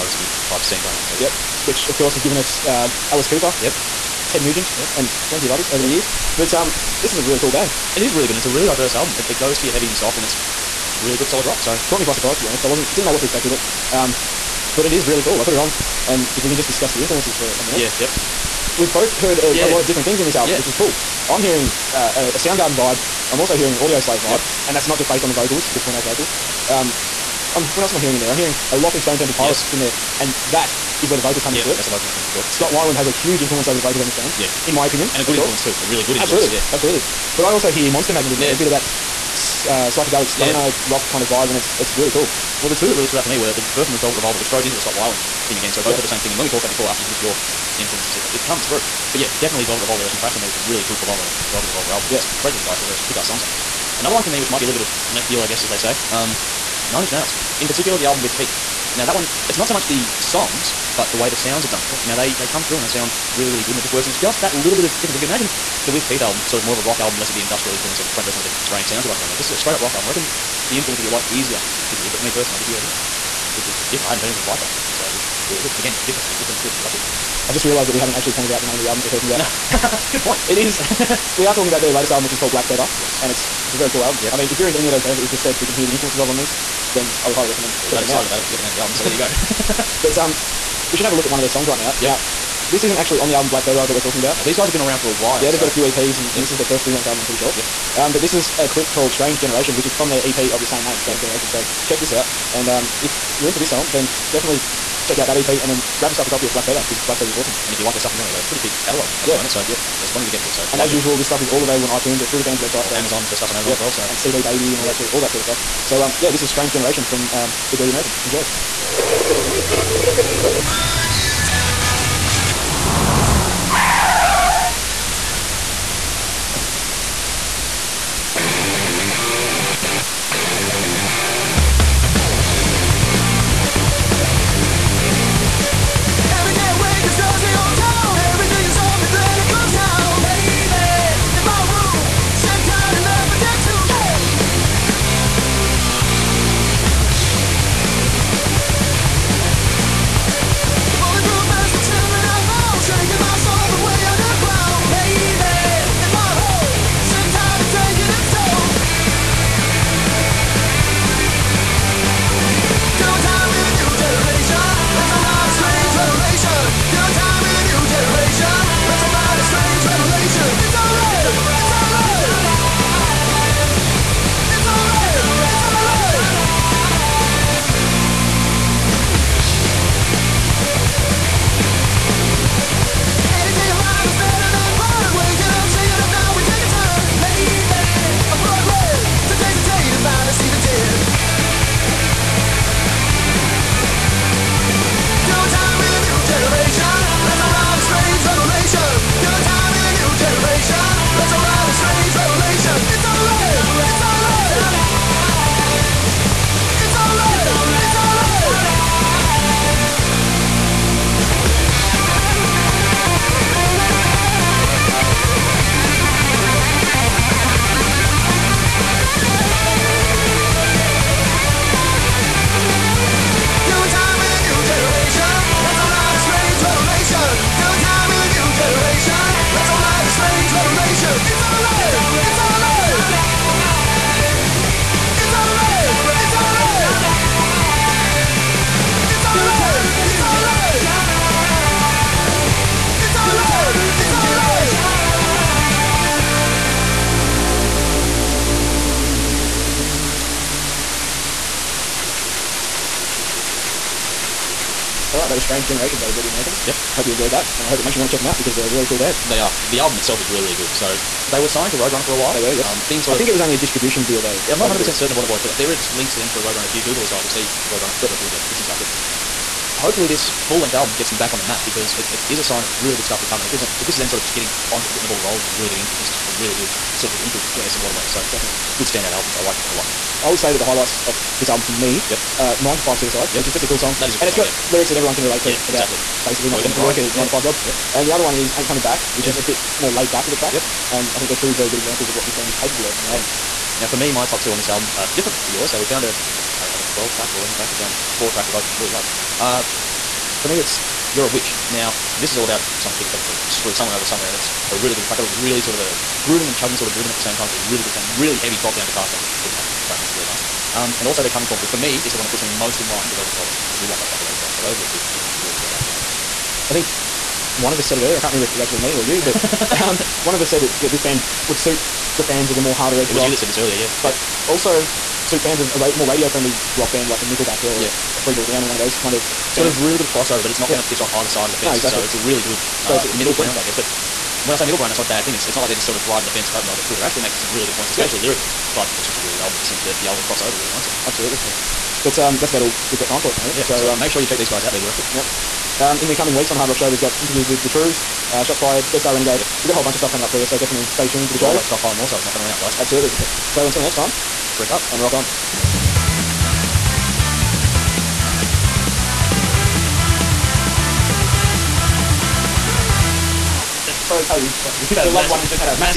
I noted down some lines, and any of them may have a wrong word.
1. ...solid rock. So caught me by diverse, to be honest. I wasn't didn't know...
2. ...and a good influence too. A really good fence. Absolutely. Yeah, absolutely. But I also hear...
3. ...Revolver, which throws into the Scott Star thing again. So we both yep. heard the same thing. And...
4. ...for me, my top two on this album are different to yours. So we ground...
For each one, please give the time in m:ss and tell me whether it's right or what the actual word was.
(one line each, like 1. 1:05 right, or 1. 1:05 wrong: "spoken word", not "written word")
1. 0:11 wrong: "surprise", not "diverse"
2. 0:35 wrong: "influence", not "fence"
3. 0:44 wrong: "Weiland", not "Star"
4. 4:53 wrong: "found", not "ground".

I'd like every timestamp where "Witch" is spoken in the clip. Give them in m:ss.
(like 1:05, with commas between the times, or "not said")
5:01.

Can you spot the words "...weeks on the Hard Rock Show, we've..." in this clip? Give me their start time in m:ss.
5:46.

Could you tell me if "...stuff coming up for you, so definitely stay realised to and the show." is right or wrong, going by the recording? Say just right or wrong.
wrong.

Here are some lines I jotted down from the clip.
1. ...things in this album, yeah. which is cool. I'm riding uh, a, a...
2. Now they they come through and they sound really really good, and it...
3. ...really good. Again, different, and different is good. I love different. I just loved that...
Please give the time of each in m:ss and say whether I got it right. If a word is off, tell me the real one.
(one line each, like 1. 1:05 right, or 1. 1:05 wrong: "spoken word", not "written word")
1. 0:20 wrong: "hearing", not "riding"
2. 1:02 right
3. 1:15 wrong: "realised", not "loved".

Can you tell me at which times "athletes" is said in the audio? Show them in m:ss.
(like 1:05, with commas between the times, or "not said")
not said.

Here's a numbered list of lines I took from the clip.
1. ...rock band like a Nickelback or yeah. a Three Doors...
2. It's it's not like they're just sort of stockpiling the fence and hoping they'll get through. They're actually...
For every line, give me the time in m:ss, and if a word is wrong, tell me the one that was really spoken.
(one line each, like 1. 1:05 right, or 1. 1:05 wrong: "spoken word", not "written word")
1. 5:26 right
2. 5:35 wrong: "riding", not "stockpiling".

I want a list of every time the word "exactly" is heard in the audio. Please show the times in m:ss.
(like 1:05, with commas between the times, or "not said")
4:45, 5:31.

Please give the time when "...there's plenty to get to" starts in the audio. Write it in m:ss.
1:49.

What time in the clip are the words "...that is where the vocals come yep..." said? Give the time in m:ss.
0:30.